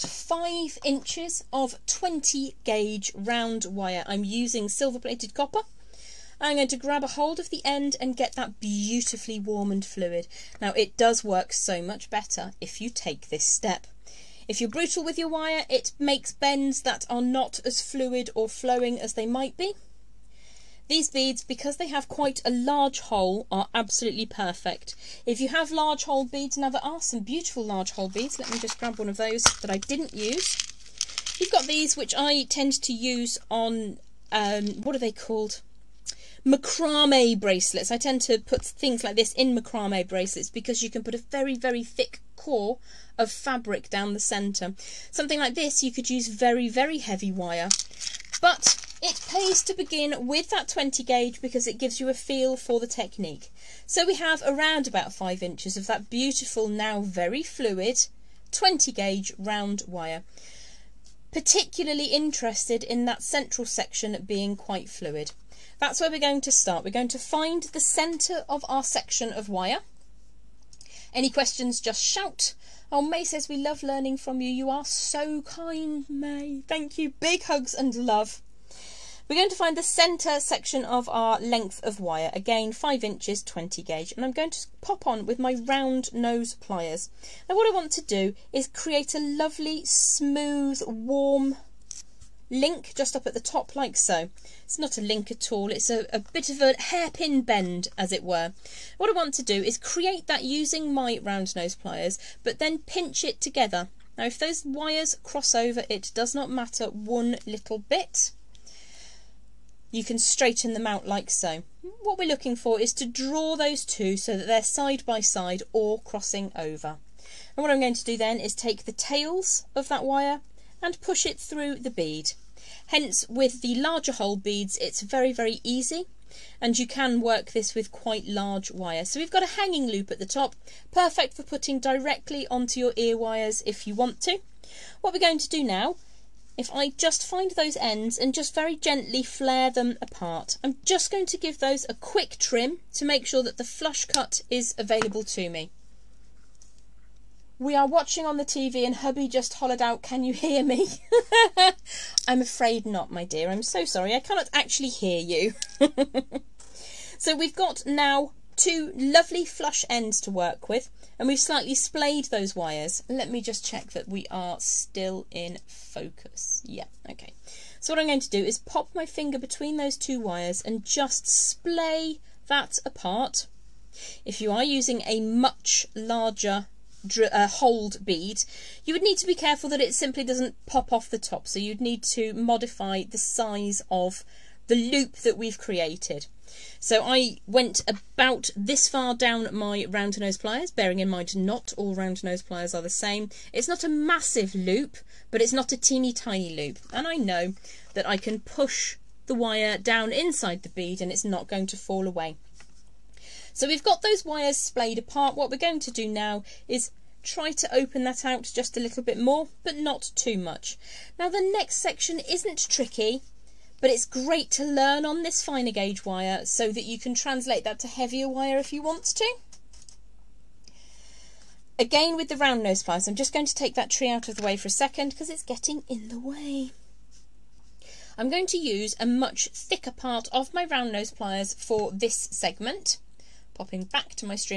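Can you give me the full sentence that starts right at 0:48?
But it pays to begin with that 20 gauge because it gives you a feel for the technique.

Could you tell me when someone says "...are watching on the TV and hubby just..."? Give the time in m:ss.
2:27.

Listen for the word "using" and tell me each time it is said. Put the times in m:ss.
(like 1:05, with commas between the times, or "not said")
0:04, 1:40, 2:54.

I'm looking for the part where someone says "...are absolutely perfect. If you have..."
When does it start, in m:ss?
0:23.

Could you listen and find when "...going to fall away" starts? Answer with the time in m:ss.
3:21.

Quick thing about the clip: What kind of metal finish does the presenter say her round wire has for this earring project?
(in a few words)
Silver plated copper.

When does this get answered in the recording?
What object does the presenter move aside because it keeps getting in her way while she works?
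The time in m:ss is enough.
3:43.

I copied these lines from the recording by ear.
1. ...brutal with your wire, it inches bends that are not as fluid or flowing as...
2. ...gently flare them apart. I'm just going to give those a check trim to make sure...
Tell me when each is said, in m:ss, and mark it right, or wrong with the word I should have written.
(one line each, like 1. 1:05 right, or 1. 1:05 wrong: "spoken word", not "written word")
1. 0:14 wrong: "makes", not "inches"
2. 2:18 wrong: "quick", not "check".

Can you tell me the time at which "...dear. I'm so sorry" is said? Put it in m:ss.
2:33.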